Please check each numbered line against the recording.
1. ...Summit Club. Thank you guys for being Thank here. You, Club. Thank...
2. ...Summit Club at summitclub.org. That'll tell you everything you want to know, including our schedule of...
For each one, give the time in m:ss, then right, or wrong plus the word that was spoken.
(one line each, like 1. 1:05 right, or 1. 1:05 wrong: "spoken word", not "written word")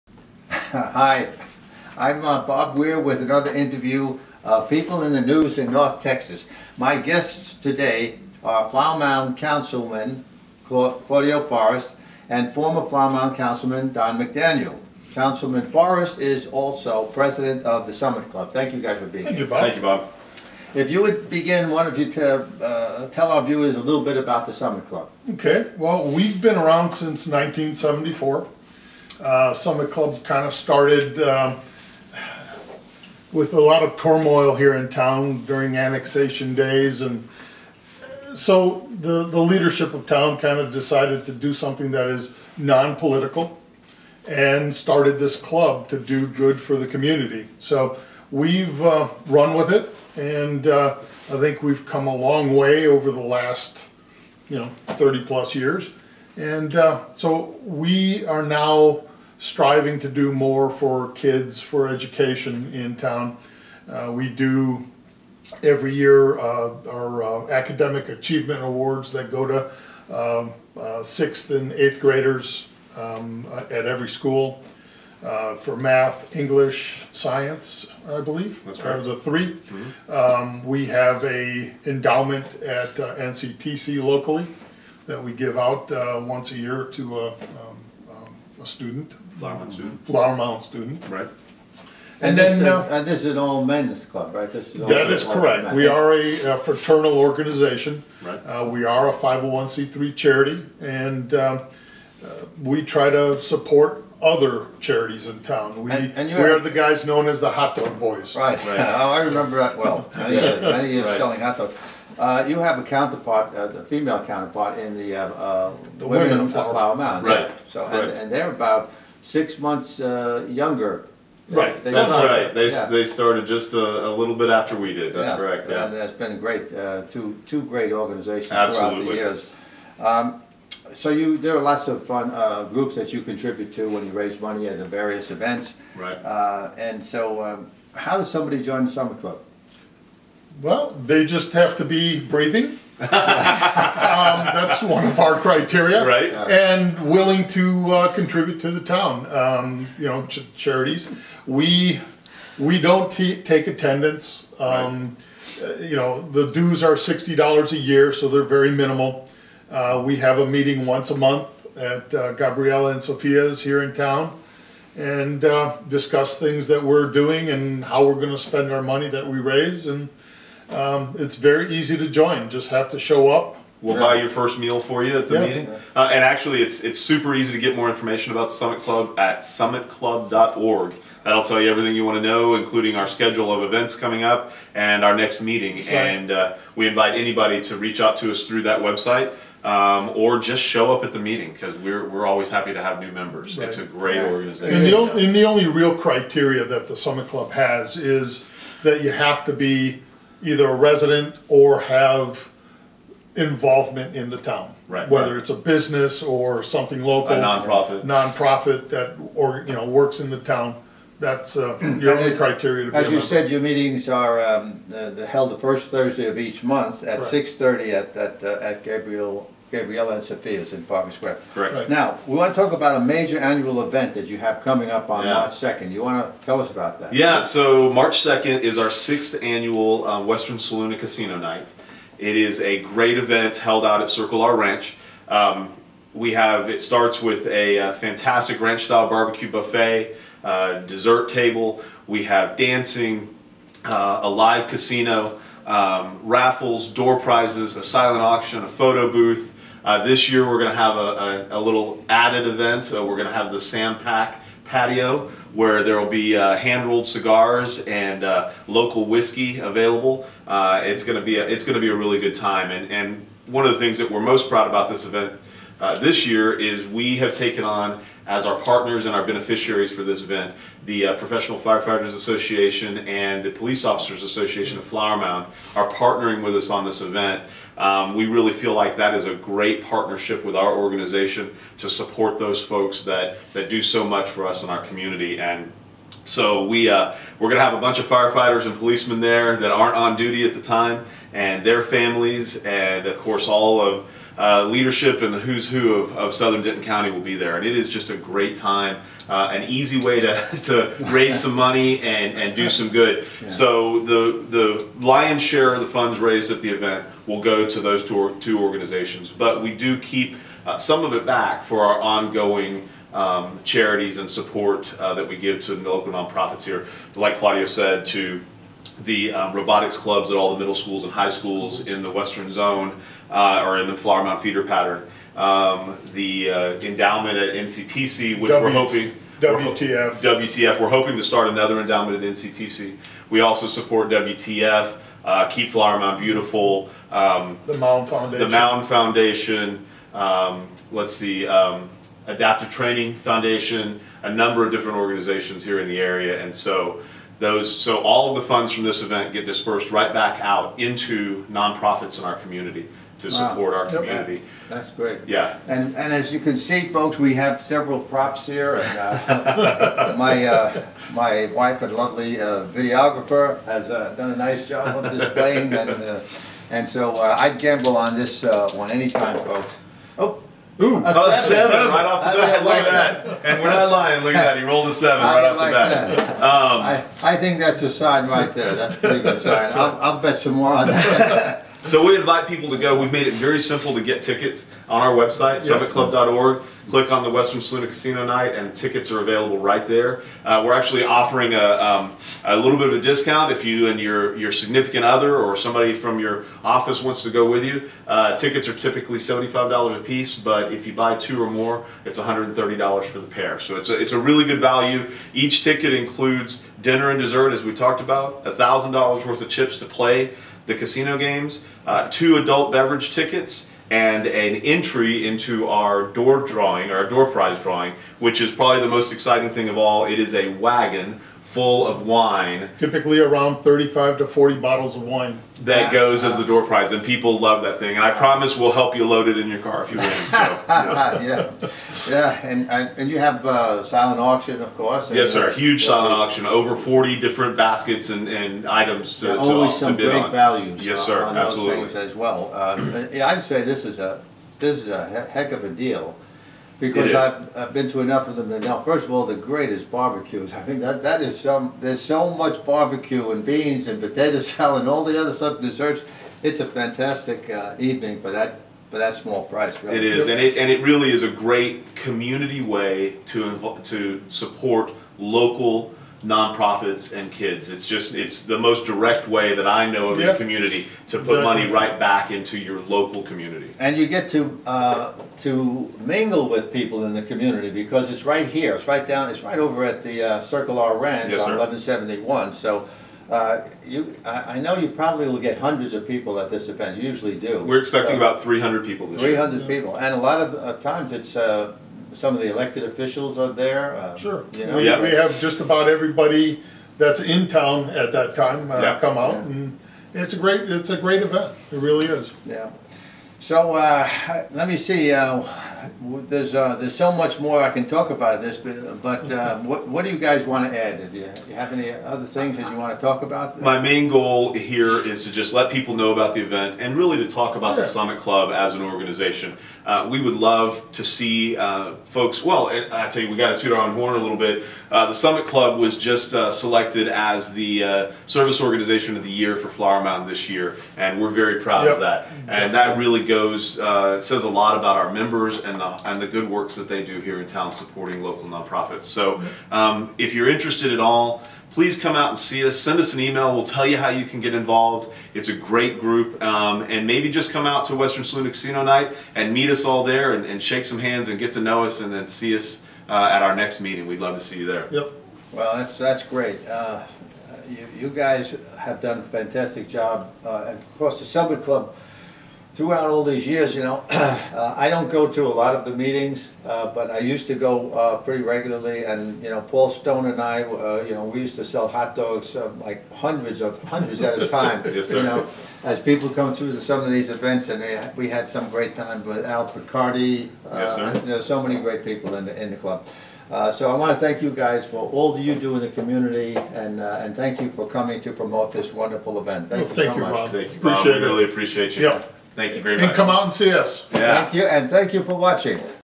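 1. 0:17 wrong: "Bob", not "Club"
2. 2:58 right.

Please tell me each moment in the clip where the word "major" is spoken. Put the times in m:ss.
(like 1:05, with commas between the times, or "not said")
3:43.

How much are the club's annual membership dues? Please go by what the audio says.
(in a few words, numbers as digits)
$60.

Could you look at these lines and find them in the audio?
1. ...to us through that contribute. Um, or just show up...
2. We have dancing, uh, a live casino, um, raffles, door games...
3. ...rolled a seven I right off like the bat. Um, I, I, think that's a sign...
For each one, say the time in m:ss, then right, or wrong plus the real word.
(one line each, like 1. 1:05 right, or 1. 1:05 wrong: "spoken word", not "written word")
1. 3:08 wrong: "website", not "contribute"
2. 4:02 wrong: "prizes", not "games"
3. 6:14 right.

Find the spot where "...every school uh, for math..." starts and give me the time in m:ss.
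1:13.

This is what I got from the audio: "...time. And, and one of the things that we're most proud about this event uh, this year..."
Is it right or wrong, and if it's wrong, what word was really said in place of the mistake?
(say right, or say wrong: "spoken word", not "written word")
right.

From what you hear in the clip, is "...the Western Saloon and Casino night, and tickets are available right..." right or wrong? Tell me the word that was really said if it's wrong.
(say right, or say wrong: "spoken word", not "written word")
right.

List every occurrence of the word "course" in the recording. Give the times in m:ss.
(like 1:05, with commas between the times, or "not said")
4:53, 7:14, 9:20.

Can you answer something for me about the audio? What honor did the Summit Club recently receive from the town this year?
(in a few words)
service organization of the year.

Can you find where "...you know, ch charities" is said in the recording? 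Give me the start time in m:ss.
2:29.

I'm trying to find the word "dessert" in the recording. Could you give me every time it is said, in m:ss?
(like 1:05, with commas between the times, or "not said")
4:00, 6:47, 7:35.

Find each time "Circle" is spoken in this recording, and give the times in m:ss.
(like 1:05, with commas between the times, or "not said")
3:54, 8:00.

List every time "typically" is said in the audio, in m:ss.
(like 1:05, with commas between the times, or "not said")
6:38, 7:02.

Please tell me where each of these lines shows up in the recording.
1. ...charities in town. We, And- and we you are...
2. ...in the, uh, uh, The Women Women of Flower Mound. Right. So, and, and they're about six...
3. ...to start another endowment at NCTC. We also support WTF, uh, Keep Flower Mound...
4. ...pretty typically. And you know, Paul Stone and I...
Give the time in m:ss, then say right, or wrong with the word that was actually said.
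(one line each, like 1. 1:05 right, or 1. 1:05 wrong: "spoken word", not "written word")
1. 1:44 right
2. 1:54 right
3. 5:31 right
4. 9:28 wrong: "regularly", not "typically".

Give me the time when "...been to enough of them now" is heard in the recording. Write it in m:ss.
7:27.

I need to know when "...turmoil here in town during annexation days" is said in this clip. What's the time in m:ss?
0:33.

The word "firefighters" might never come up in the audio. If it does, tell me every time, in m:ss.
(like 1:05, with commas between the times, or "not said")
4:31, 4:48.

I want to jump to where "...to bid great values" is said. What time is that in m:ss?
7:19.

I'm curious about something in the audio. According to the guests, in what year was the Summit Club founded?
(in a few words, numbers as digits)
1974.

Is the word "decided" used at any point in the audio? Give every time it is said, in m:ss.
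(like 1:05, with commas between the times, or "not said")
0:40.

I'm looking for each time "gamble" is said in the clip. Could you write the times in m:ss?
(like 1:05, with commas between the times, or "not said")
6:07.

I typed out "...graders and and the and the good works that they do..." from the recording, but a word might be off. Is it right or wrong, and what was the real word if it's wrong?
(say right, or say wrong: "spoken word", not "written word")
wrong: "members", not "graders".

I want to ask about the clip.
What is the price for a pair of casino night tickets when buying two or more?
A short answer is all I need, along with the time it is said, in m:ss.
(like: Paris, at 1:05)
$130, at 6:42.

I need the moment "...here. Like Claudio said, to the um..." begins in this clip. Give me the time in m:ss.
5:16.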